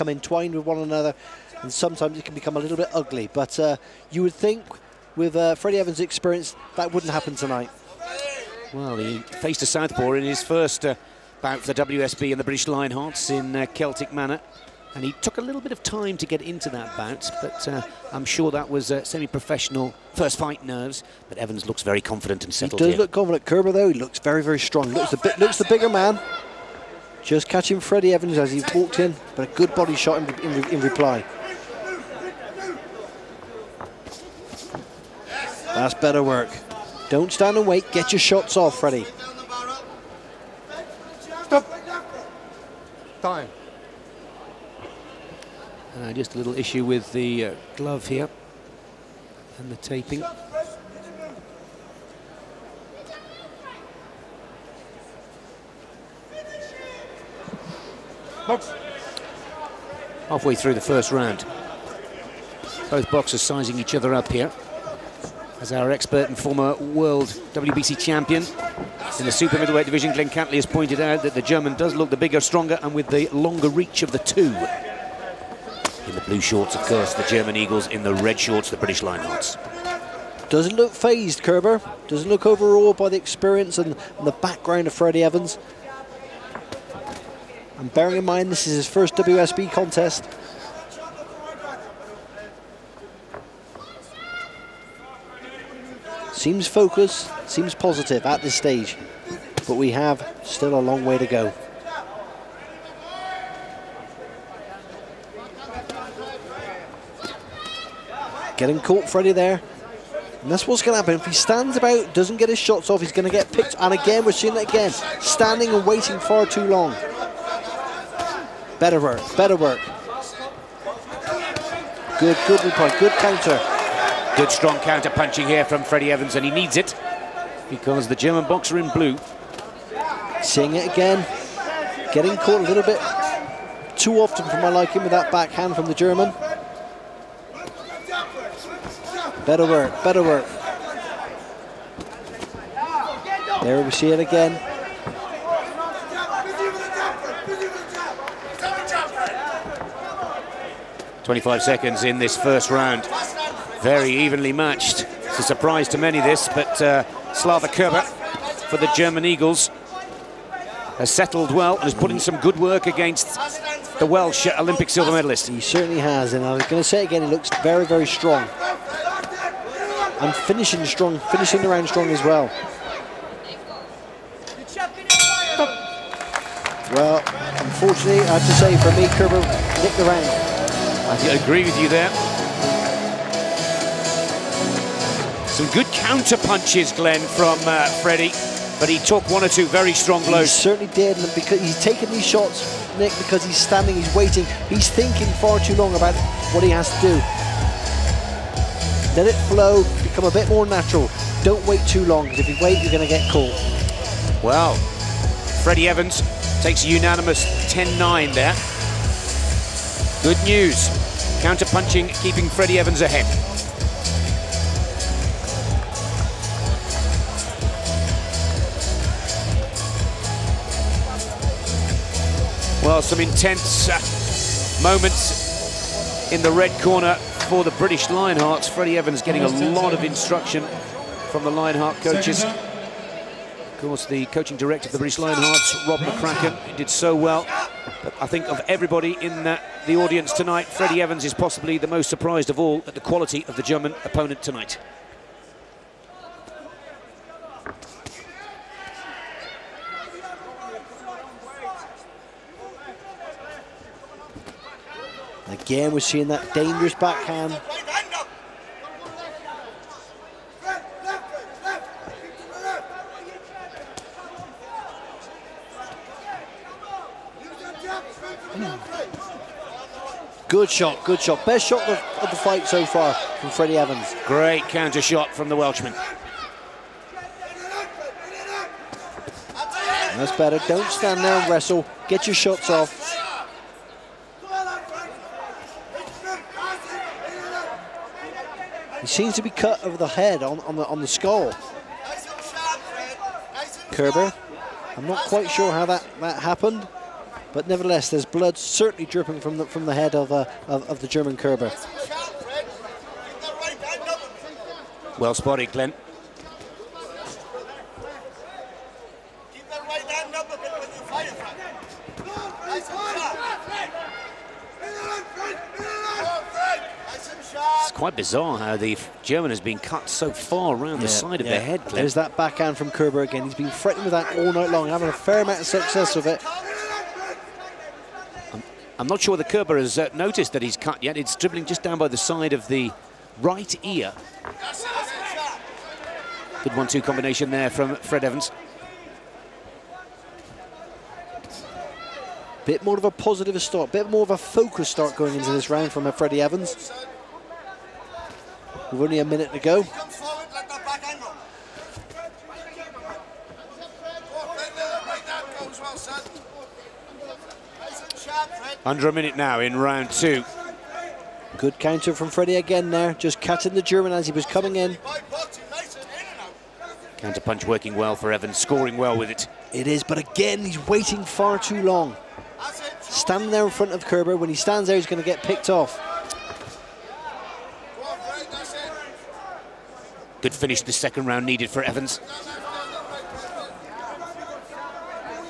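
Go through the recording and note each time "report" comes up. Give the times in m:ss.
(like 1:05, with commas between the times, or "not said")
2:02.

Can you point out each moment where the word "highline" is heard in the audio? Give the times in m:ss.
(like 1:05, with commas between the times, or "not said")
not said.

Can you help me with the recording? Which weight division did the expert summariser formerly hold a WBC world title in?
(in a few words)
super middleweight.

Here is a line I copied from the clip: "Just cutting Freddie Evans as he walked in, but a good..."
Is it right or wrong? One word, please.
wrong.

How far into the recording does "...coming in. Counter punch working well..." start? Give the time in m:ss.
6:04.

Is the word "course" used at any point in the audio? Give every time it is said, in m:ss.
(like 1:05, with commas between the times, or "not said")
1:16, 3:53.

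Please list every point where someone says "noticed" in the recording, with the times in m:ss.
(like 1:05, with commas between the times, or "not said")
5:30.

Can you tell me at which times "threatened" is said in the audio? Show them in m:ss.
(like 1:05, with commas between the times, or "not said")
5:23.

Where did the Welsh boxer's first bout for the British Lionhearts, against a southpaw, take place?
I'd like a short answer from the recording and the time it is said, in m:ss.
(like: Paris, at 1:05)
Celtic Manor, at 0:13.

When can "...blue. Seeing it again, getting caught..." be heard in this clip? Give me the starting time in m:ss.
2:08.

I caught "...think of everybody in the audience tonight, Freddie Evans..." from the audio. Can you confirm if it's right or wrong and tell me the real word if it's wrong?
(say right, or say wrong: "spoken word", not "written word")
right.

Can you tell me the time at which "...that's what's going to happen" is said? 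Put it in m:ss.
1:50.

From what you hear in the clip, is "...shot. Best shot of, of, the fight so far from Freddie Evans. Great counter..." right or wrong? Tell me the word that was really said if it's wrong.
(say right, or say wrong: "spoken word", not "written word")
right.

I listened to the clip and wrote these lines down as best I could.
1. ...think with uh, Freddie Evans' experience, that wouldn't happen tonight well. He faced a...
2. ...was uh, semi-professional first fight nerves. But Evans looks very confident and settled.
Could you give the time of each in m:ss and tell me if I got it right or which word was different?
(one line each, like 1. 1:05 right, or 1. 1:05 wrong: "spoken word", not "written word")
1. 0:04 right
2. 0:18 right.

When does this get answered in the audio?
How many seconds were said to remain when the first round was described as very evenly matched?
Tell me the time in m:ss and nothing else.
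2:31.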